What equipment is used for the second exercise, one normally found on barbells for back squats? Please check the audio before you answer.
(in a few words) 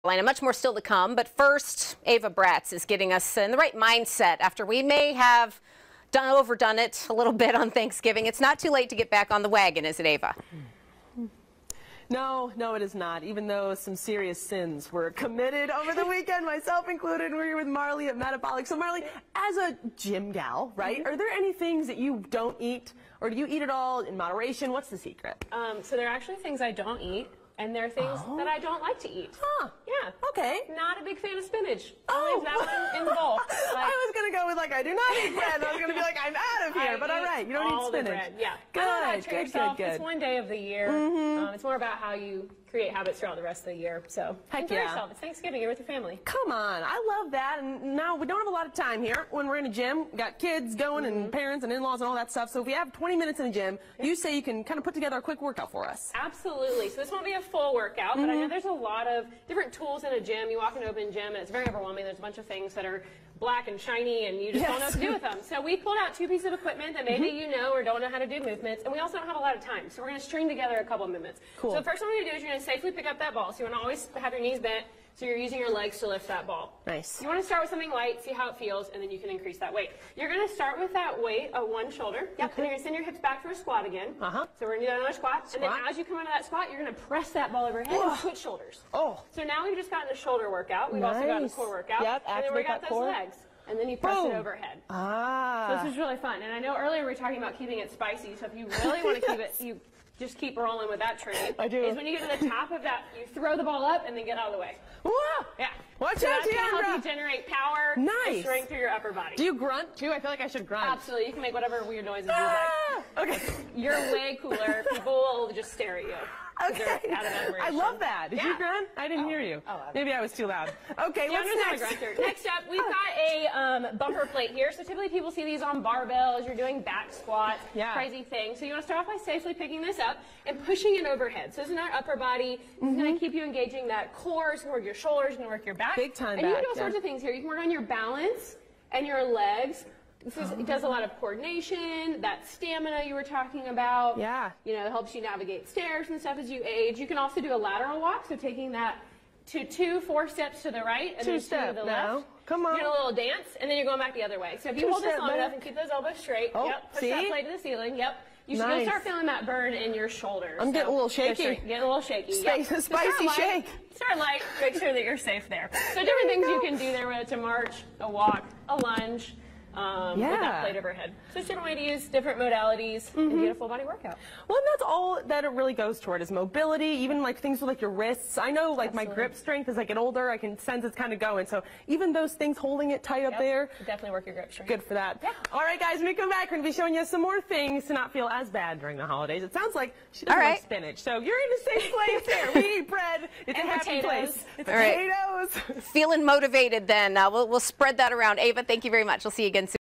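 Bumper plate.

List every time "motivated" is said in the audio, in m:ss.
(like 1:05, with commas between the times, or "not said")
3:16.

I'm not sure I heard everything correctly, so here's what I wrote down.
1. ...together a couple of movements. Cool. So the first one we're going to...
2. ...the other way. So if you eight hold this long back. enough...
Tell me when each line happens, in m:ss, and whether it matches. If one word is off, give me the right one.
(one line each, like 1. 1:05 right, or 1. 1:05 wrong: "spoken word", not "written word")
1. 1:10 right
2. 2:34 wrong: "two", not "eight".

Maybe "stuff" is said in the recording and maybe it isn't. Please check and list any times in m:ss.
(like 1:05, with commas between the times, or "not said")
0:52, 2:26.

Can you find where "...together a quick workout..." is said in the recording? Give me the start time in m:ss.
0:54.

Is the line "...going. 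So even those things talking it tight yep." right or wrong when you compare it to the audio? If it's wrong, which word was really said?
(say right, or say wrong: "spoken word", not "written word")
wrong: "holding", not "talking".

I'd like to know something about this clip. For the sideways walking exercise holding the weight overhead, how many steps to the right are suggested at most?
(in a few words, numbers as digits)
4.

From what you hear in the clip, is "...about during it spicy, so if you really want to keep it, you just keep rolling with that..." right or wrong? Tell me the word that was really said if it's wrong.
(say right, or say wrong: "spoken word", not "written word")
wrong: "keeping", not "during".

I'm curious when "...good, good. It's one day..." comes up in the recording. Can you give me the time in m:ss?
0:39.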